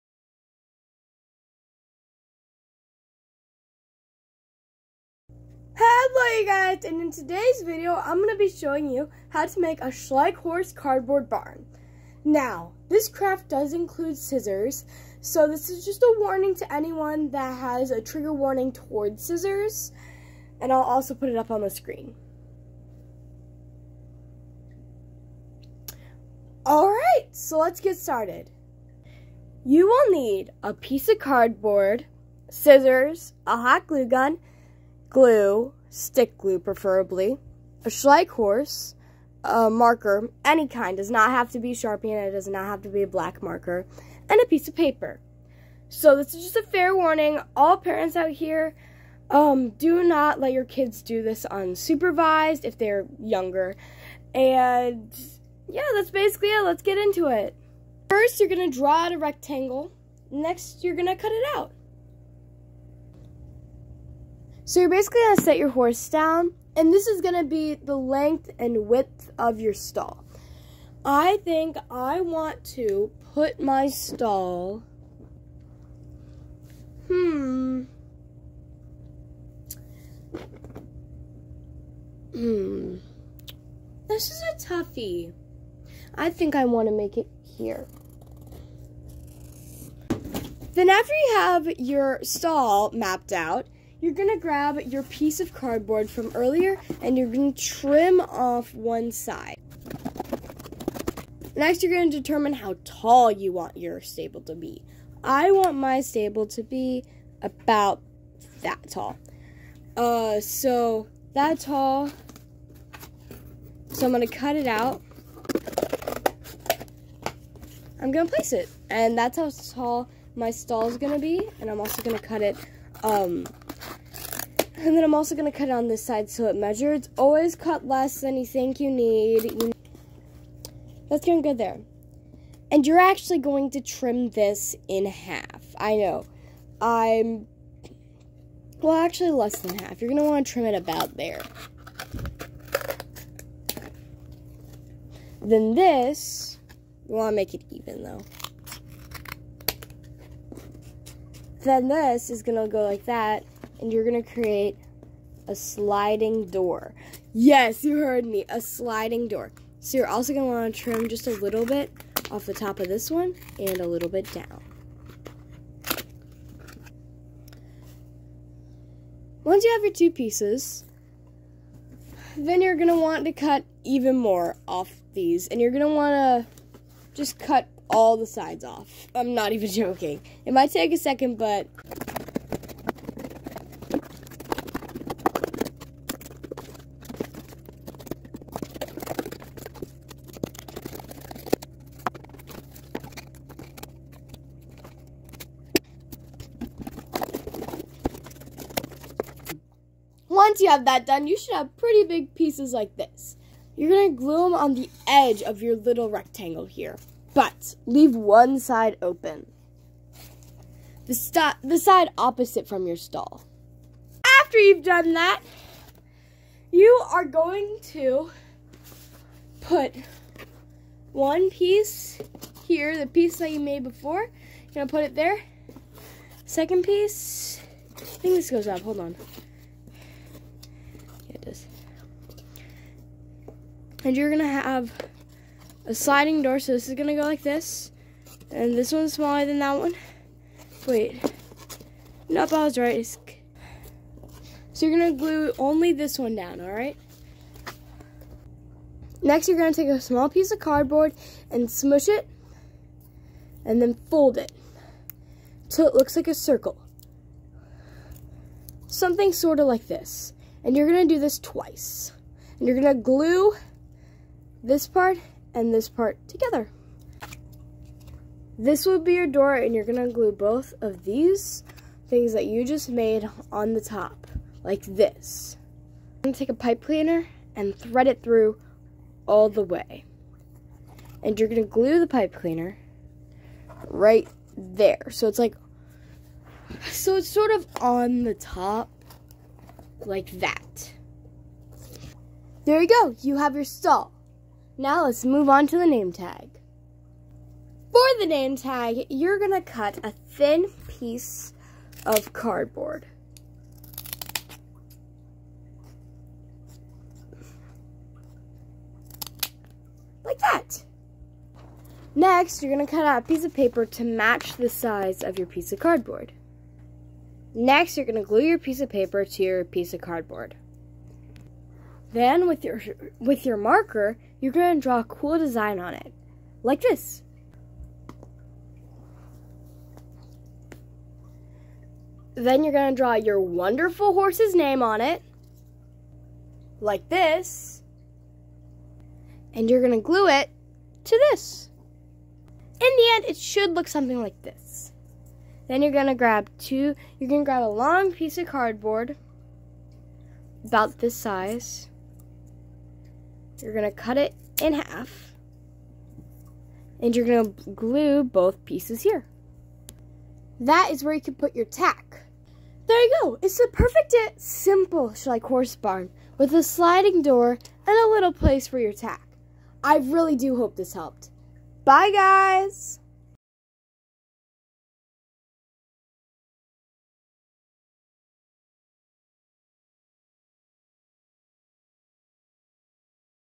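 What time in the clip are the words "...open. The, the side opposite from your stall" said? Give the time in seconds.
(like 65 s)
209 s.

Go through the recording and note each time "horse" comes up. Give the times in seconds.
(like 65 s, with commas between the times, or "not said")
10 s, 38 s, 65 s, 334 s, 365 s.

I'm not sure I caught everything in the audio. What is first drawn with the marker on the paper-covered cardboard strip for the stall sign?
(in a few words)
A cool design.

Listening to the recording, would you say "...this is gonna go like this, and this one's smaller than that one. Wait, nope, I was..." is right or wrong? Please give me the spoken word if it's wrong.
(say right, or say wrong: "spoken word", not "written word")
right.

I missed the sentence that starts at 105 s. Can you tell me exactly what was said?
I want my stable to be about that tall.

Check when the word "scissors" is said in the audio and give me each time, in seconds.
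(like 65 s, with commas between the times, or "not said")
14 s, 19 s, 32 s.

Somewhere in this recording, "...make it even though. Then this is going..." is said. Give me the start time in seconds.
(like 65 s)
147 s.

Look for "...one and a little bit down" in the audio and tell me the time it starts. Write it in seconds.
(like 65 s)
163 s.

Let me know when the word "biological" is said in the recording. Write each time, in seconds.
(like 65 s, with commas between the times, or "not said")
not said.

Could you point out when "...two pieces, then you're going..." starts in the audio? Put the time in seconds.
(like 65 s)
169 s.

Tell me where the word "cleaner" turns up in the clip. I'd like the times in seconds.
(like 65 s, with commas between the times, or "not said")
276 s, 282 s.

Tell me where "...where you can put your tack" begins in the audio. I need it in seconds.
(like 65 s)
361 s.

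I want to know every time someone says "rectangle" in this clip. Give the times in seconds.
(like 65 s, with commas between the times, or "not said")
59 s, 206 s.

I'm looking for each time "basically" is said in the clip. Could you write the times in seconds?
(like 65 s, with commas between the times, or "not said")
56 s, 64 s.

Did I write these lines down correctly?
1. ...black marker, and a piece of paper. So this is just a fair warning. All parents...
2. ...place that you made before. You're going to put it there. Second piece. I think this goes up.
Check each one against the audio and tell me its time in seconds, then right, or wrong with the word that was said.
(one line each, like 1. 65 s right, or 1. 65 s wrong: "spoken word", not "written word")
1. 43 s right
2. 223 s wrong: "piece", not "place".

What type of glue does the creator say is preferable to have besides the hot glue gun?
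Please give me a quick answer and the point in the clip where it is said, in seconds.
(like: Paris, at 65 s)
Stick glue, at 35 s.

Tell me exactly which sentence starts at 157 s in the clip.
Yes, you heard me, a sliding door.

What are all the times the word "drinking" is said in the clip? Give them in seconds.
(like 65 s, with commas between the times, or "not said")
not said.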